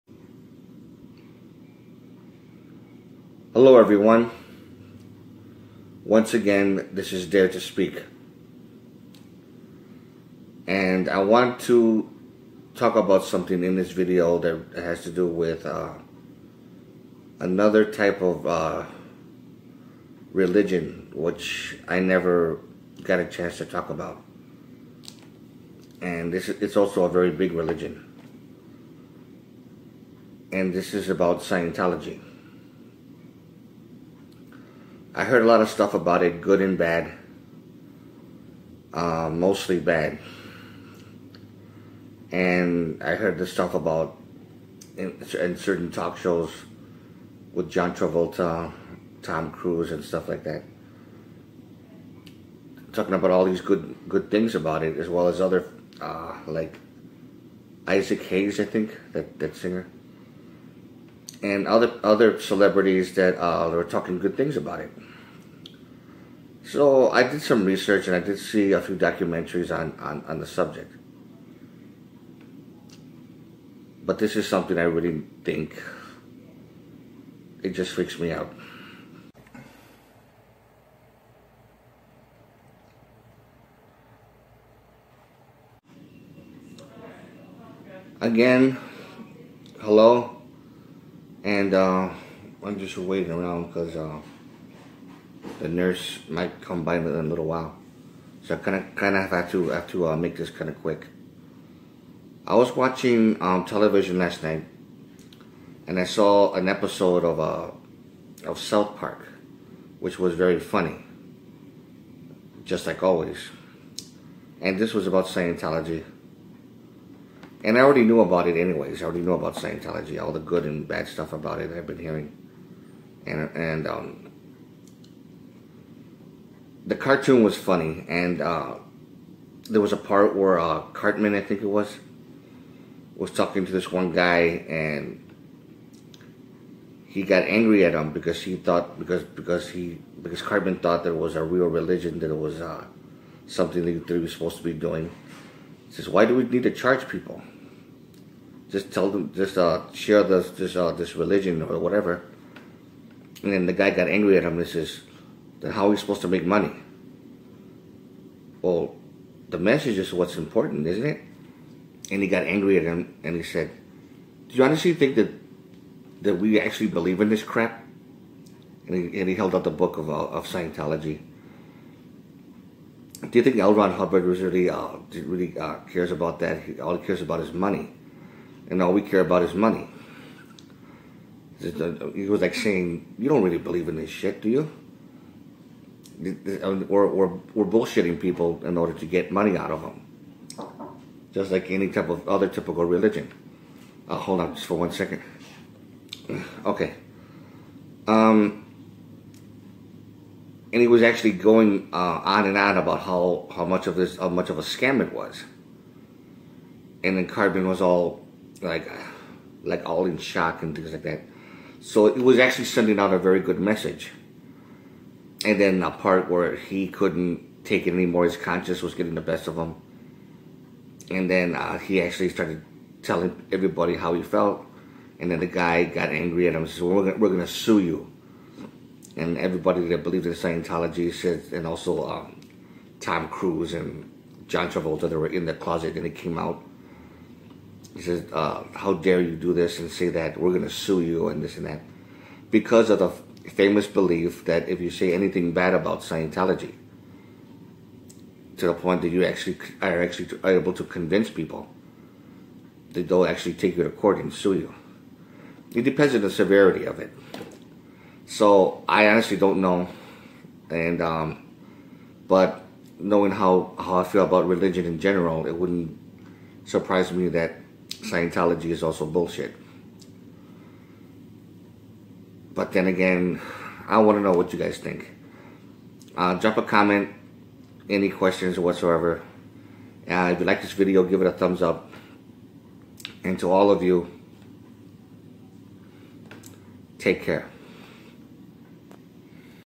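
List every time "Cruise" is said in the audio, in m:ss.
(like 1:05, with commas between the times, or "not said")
0:49, 3:53.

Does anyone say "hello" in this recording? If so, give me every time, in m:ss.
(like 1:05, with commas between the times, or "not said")
0:03, 1:29.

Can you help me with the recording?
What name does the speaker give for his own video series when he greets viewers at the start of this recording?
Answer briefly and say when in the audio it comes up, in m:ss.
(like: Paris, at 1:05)
Dare to Speak, at 0:07.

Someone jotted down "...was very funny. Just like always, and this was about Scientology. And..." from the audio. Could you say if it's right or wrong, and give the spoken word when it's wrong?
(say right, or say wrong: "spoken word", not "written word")
right.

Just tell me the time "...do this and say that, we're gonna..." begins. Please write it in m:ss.
3:59.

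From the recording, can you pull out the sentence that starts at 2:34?
and says then how are we supposed to make money?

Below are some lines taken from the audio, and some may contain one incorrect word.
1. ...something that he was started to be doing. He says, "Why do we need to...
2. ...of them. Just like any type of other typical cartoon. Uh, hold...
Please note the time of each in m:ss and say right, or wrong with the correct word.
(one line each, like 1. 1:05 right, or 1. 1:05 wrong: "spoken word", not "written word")
1. 2:23 wrong: "supposed", not "started"
2. 3:09 wrong: "religion", not "cartoon".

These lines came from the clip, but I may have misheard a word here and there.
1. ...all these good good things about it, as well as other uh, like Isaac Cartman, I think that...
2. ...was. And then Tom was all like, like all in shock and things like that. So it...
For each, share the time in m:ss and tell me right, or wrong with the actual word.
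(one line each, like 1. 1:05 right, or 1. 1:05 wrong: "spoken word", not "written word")
1. 0:53 wrong: "Hayes", not "Cartman"
2. 3:25 wrong: "Cartman", not "Tom".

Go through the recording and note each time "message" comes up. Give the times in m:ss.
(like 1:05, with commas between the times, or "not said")
2:39, 3:33.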